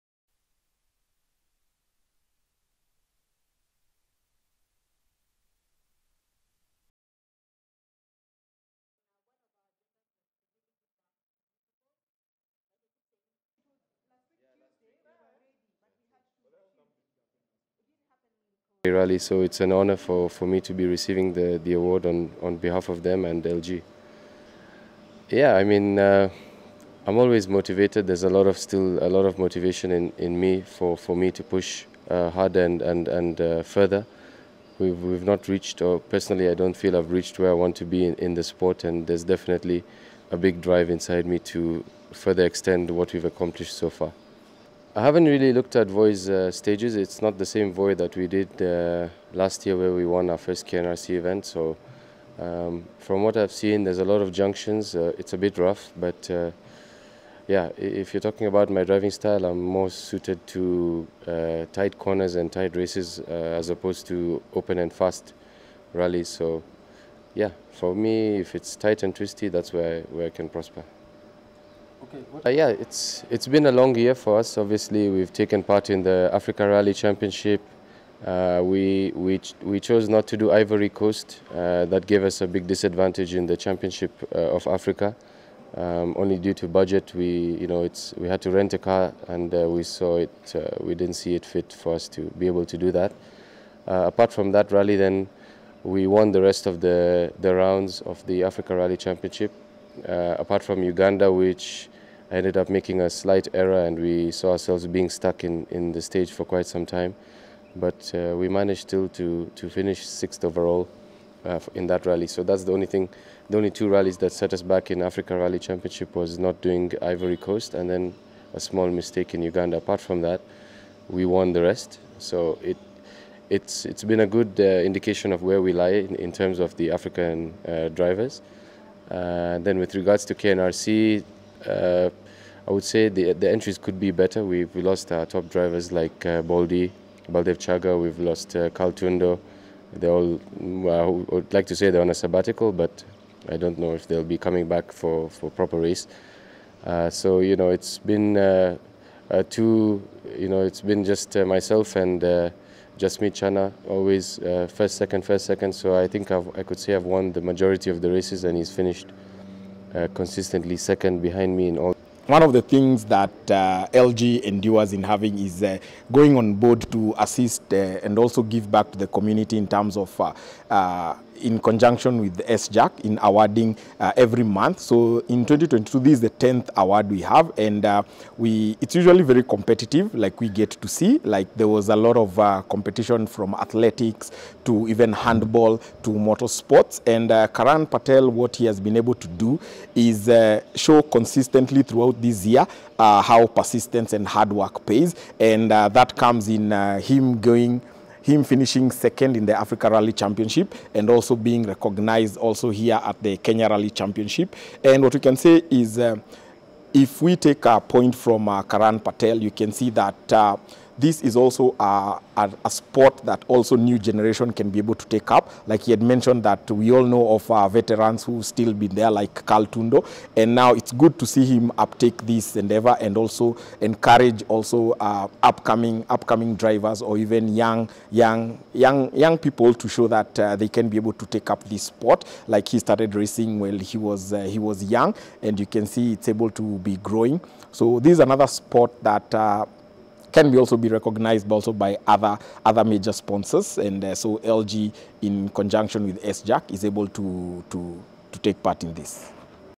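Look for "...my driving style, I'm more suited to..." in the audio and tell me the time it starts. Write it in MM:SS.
00:58.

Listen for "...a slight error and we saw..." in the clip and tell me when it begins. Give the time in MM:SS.
01:43.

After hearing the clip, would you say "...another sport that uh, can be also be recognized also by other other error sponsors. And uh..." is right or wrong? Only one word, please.
wrong.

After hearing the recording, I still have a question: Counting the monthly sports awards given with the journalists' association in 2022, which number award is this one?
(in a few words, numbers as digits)
10th.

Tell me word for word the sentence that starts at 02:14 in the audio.
We we lost our top drivers like uh, Baldi, Baldev Chager.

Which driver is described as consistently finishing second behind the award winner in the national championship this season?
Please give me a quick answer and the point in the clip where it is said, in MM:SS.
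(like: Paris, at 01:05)
Chana, at 02:33.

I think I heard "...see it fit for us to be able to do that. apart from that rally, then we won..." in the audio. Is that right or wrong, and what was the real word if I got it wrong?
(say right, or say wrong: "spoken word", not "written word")
right.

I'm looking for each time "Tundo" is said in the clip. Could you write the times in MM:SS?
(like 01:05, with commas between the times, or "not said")
02:18, 03:39.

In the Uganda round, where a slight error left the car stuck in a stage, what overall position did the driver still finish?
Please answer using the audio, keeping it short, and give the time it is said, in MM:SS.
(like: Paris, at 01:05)
Sixth, at 01:50.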